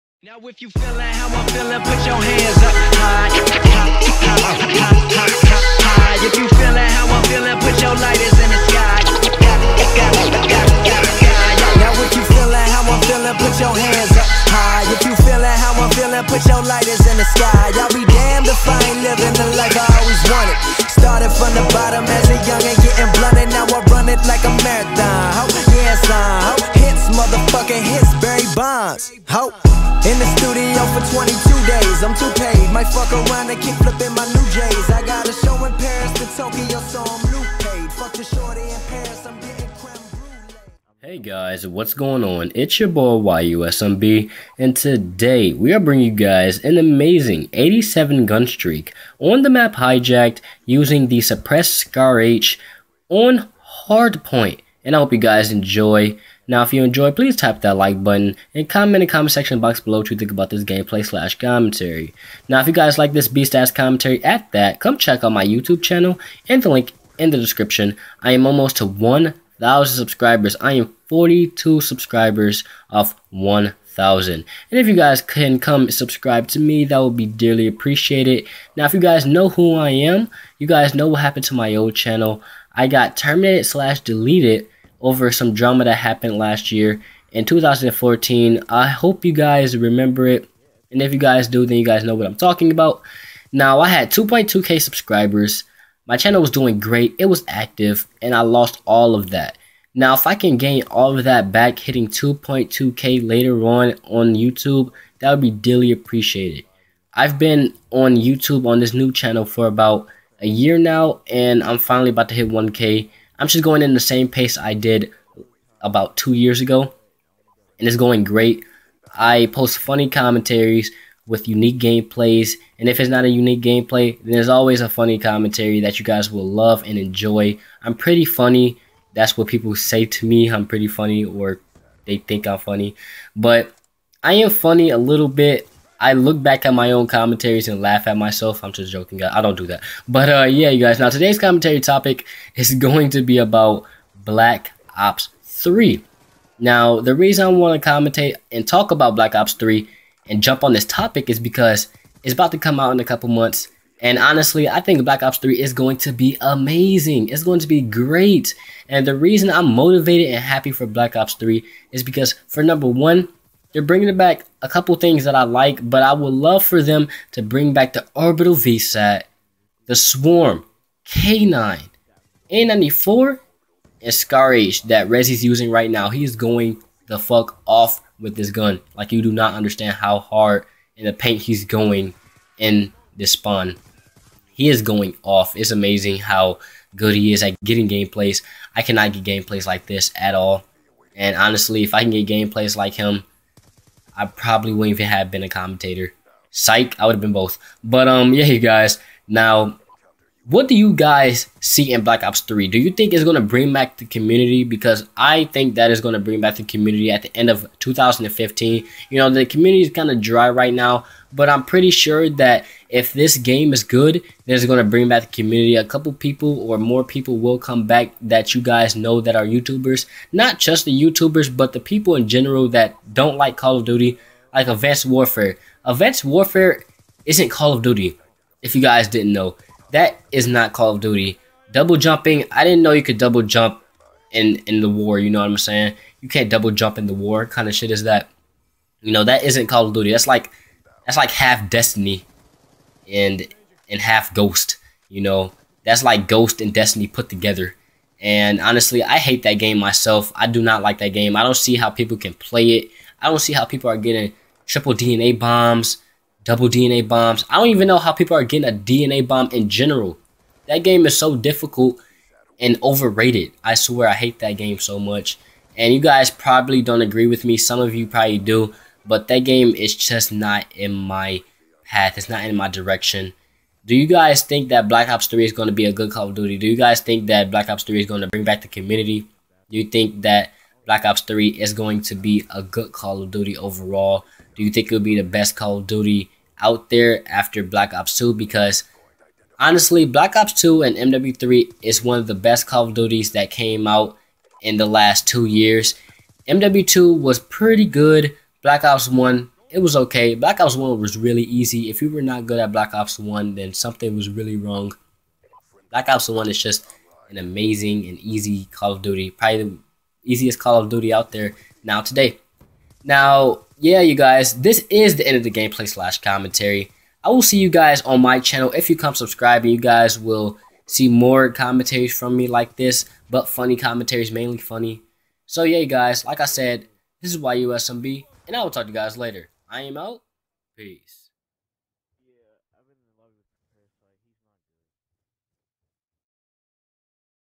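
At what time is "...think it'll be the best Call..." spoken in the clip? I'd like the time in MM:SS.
04:44.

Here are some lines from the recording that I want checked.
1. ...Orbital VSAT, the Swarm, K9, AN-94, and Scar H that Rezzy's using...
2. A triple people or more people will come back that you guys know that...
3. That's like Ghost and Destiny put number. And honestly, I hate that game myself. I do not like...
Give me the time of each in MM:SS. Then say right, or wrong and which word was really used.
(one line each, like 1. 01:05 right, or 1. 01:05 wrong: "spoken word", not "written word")
1. 02:48 right
2. 03:35 wrong: "couple", not "triple"
3. 04:05 wrong: "together", not "number".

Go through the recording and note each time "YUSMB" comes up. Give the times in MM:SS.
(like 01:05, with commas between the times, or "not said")
00:43, 05:27.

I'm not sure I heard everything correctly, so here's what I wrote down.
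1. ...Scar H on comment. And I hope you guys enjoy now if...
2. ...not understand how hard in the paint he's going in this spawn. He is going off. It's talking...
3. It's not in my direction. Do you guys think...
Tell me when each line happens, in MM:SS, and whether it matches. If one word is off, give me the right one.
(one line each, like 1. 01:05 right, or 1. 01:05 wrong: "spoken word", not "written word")
1. 00:51 wrong: "hardpoint", not "comment"
2. 02:59 wrong: "amazing", not "talking"
3. 04:32 right.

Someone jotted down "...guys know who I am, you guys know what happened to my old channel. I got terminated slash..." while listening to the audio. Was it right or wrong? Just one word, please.
right.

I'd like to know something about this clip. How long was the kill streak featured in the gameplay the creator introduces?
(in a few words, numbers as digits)
87.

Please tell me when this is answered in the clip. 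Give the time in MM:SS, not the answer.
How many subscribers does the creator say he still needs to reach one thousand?
01:11.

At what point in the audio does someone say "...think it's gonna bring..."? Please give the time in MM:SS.
03:22.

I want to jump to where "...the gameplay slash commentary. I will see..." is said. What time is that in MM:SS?
05:15.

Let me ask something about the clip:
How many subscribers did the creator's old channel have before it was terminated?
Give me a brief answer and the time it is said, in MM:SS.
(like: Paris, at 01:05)
2.2k, at 01:34.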